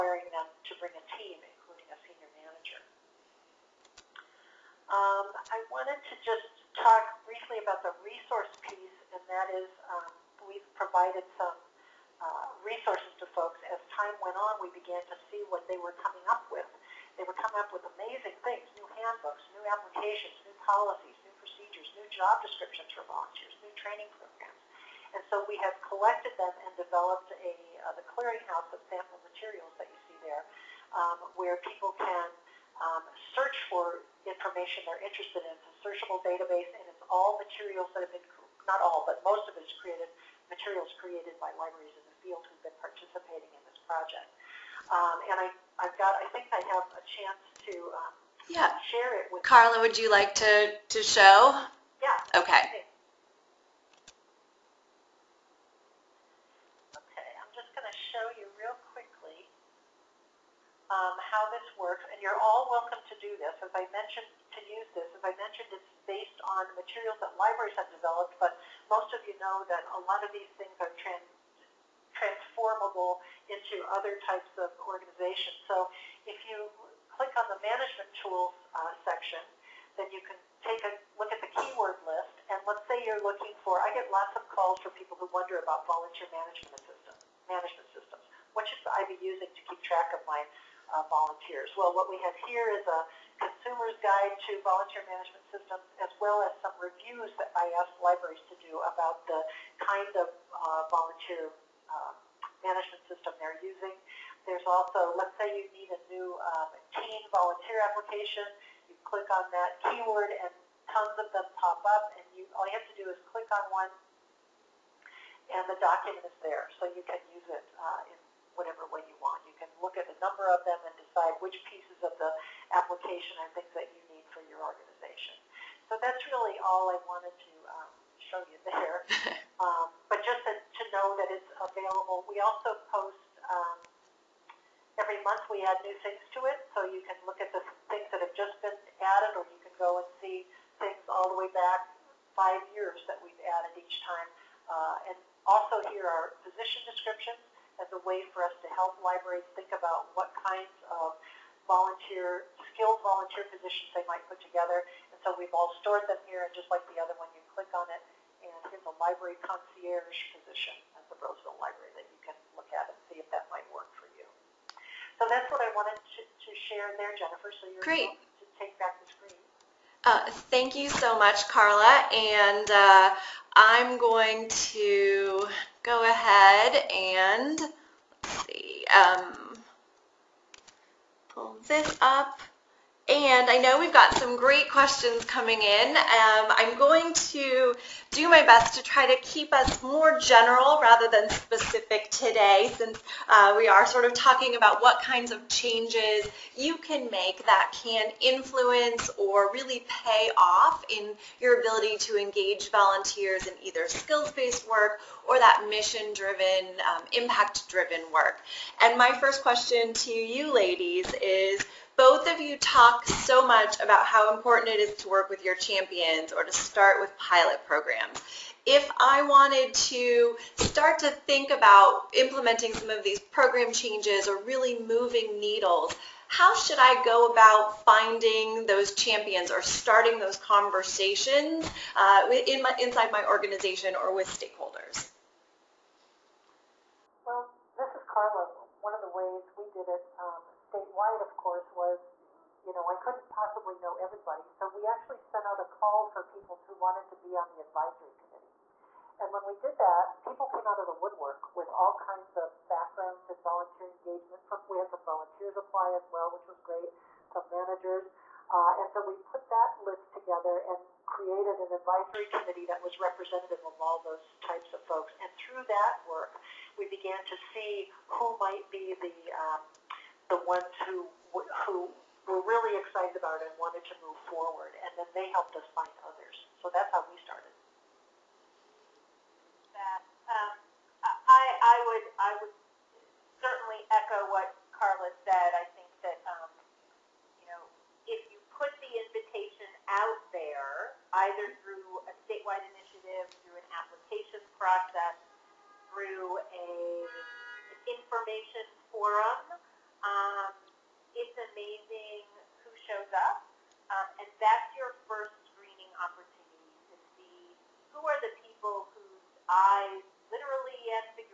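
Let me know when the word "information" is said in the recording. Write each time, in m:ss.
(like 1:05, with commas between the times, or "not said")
0:34, 4:57.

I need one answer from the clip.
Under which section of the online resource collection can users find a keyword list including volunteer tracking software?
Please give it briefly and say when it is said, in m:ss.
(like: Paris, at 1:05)
management tools, at 1:17.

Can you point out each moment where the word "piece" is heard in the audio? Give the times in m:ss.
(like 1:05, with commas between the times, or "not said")
0:08, 2:01.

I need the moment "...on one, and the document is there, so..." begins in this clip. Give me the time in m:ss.
1:53.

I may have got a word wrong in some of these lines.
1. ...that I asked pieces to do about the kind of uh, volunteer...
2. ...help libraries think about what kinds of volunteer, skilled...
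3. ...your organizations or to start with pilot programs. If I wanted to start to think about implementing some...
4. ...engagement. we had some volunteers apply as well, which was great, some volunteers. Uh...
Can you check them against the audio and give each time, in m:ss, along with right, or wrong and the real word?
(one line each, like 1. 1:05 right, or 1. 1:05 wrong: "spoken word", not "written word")
1. 1:37 wrong: "libraries", not "pieces"
2. 2:28 right
3. 3:35 wrong: "champions", not "organizations"
4. 4:14 wrong: "managers", not "volunteers".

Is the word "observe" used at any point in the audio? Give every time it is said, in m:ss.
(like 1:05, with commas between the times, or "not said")
not said.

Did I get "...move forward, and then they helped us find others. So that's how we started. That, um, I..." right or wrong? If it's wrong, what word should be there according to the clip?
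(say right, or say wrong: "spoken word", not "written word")
right.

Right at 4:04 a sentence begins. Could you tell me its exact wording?
So we actually sent out a call for people who wanted to be on the advisory committee.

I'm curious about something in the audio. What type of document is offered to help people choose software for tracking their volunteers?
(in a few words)
consumer's guide.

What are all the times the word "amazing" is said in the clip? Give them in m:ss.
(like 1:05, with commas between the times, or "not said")
0:17, 5:01.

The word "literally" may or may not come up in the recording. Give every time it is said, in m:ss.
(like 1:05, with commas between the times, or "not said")
5:10.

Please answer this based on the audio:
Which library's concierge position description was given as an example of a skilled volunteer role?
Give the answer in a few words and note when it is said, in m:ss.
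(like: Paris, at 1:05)
Roseville Library, at 2:41.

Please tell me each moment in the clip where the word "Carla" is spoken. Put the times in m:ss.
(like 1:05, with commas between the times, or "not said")
0:49, 2:51, 3:58, 4:44.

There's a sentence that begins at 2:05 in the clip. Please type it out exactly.
So that's really all I wanted to um, show you there.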